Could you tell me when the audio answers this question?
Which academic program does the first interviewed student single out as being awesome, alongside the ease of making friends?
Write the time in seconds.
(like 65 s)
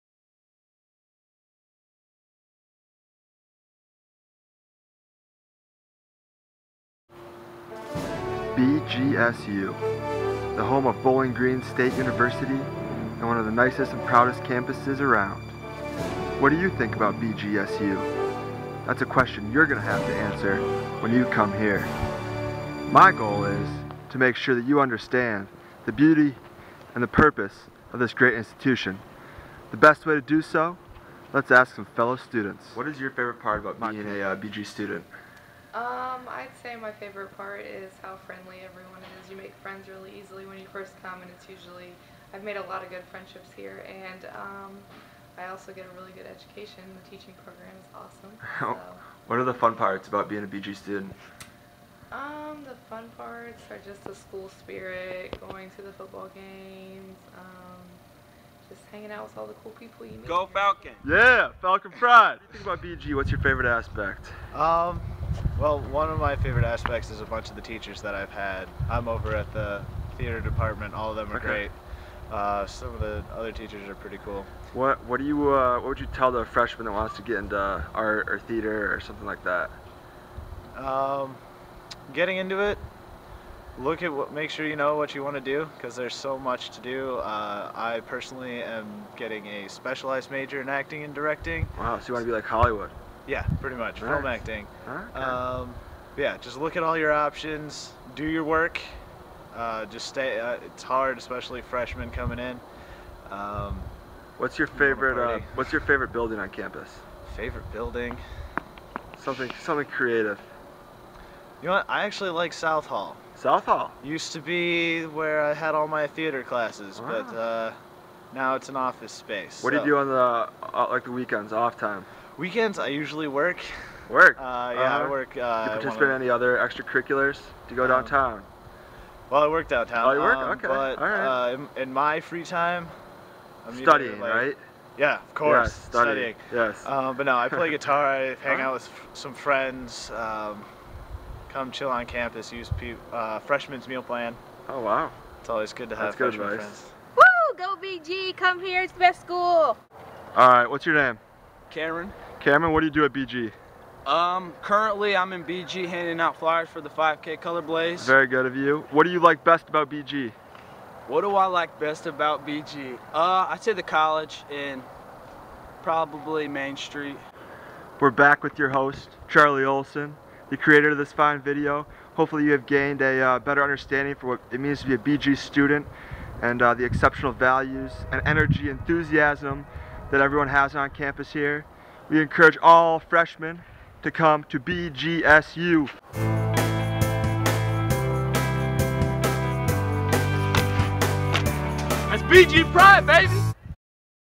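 47 s.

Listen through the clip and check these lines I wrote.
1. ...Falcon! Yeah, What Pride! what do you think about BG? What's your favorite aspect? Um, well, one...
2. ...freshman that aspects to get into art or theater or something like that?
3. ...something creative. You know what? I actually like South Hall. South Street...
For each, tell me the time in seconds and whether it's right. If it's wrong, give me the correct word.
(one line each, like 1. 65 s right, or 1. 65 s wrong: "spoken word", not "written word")
1. 60 s wrong: "Falcon", not "What"
2. 76 s wrong: "wants", not "aspects"
3. 109 s wrong: "Hall", not "Street".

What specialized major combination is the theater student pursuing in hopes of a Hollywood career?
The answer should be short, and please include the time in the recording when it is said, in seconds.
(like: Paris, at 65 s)
Acting and directing, at 90 s.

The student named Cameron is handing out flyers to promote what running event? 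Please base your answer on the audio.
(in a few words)
5K Color Blaze.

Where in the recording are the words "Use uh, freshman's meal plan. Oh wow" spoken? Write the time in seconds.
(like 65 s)
142 s.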